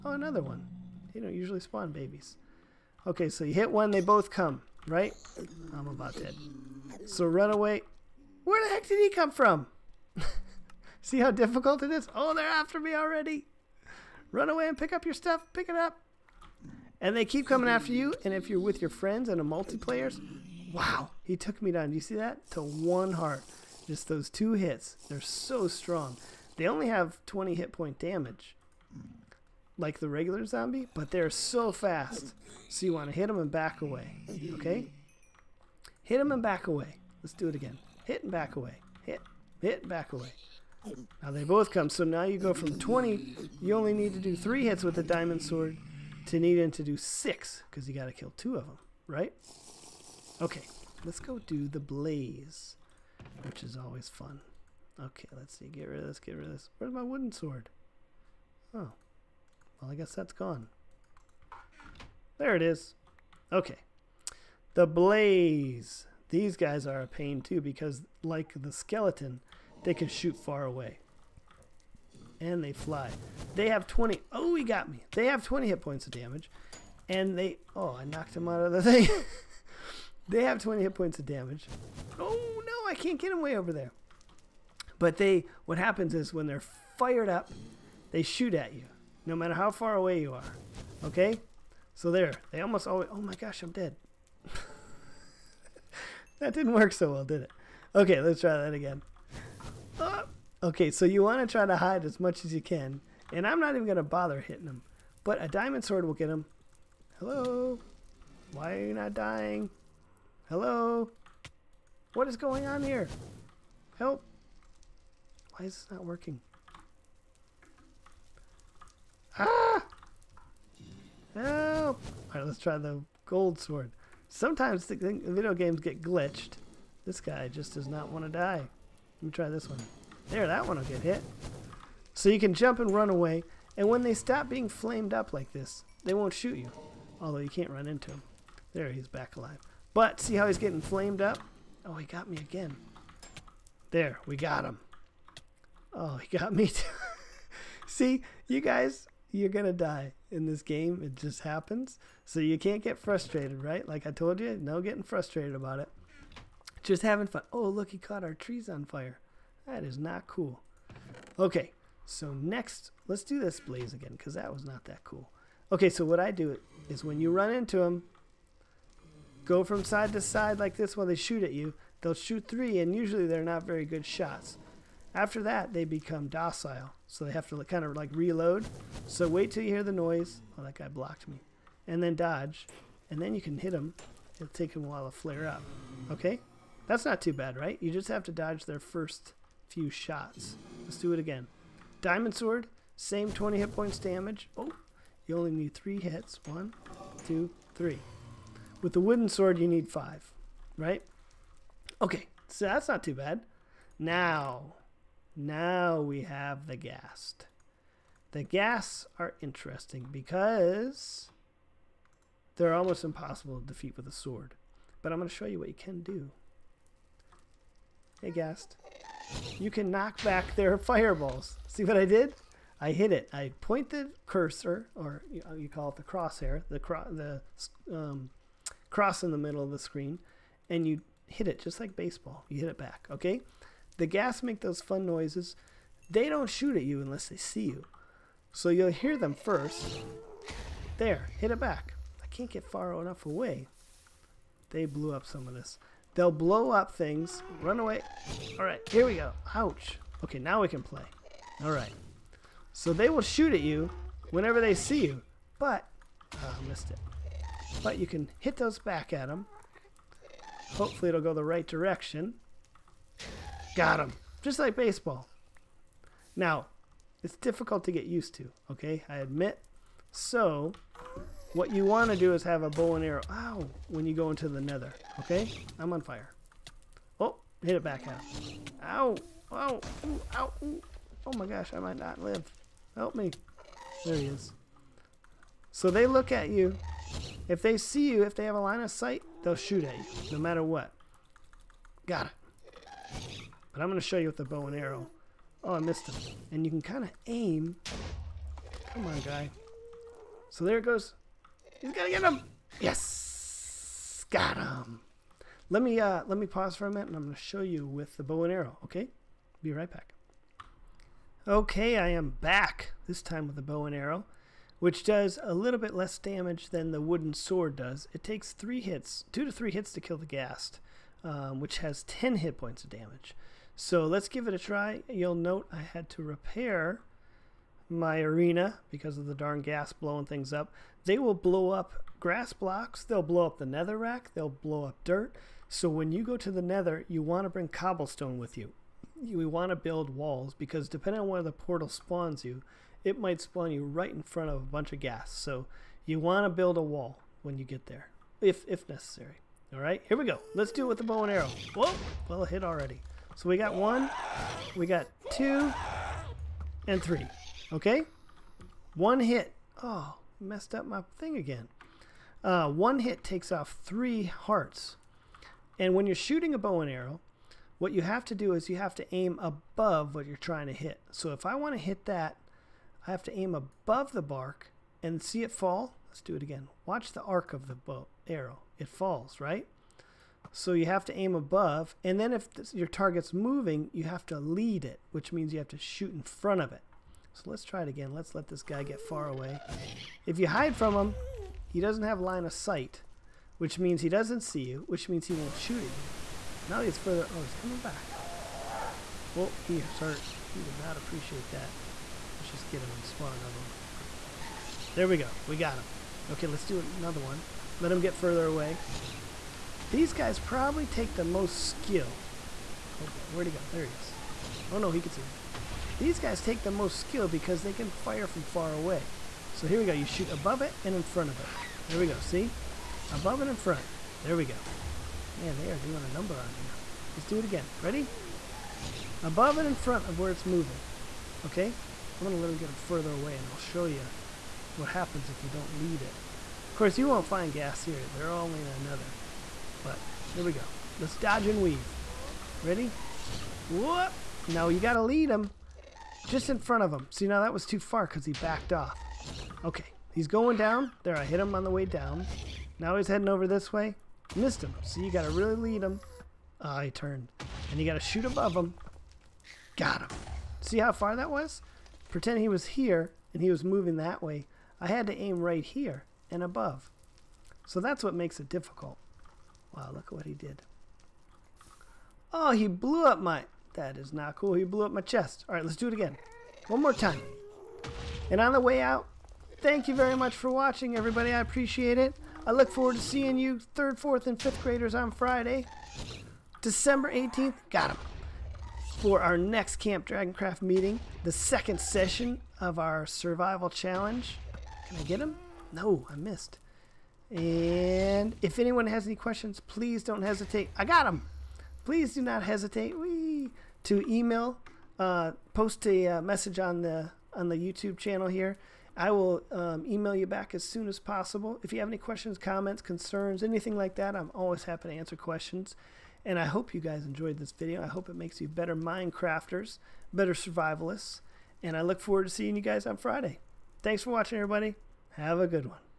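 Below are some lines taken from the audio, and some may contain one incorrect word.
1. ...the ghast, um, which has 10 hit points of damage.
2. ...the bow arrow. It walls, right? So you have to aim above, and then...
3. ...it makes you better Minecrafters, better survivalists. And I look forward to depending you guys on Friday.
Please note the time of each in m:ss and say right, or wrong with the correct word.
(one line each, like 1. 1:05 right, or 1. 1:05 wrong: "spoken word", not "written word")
1. 5:20 right
2. 6:17 wrong: "falls", not "walls"
3. 8:38 wrong: "seeing", not "depending".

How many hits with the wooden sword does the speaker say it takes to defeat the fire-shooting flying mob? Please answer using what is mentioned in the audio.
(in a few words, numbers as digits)
5.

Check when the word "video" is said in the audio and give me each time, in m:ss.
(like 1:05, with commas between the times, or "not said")
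2:04, 8:37.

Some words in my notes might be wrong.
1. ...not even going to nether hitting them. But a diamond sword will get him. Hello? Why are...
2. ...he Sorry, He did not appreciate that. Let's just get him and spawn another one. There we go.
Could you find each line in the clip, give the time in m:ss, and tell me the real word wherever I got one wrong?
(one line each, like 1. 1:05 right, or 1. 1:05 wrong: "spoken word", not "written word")
1. 1:43 wrong: "bother", not "nether"
2. 6:39 right.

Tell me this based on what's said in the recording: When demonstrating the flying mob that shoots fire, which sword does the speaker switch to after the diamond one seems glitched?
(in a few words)
gold sword.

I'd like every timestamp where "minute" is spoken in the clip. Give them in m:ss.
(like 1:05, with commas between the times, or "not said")
5:06.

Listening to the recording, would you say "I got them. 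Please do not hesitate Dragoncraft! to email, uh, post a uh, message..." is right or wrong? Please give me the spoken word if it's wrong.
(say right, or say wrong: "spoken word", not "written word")
wrong: "Whee", not "Dragoncraft".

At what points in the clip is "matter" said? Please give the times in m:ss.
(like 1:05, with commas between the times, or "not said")
1:29, 4:50.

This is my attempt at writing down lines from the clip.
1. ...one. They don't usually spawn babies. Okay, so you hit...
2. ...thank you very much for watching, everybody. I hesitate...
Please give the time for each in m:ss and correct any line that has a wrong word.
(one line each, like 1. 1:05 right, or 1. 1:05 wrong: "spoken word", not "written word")
1. 0:00 right
2. 7:59 wrong: "appreciate", not "hesitate".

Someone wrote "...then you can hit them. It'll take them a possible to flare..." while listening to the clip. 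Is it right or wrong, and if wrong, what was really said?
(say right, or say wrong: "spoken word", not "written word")
wrong: "while", not "possible".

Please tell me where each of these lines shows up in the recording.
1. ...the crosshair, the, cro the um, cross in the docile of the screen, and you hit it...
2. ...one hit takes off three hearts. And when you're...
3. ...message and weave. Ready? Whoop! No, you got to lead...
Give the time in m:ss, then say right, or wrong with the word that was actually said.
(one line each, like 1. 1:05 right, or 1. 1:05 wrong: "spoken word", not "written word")
1. 3:45 wrong: "middle", not "docile"
2. 6:02 right
3. 7:21 wrong: "dodge", not "message".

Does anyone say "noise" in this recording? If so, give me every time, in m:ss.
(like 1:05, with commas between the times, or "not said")
2:59, 3:55.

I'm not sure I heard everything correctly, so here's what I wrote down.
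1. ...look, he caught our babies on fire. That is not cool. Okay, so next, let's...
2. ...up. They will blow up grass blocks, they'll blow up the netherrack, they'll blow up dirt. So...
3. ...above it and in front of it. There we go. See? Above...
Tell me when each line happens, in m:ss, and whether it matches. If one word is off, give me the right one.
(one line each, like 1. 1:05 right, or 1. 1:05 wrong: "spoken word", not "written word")
1. 2:37 wrong: "trees", not "babies"
2. 5:30 right
3. 7:00 right.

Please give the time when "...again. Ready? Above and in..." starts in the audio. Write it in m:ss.
7:07.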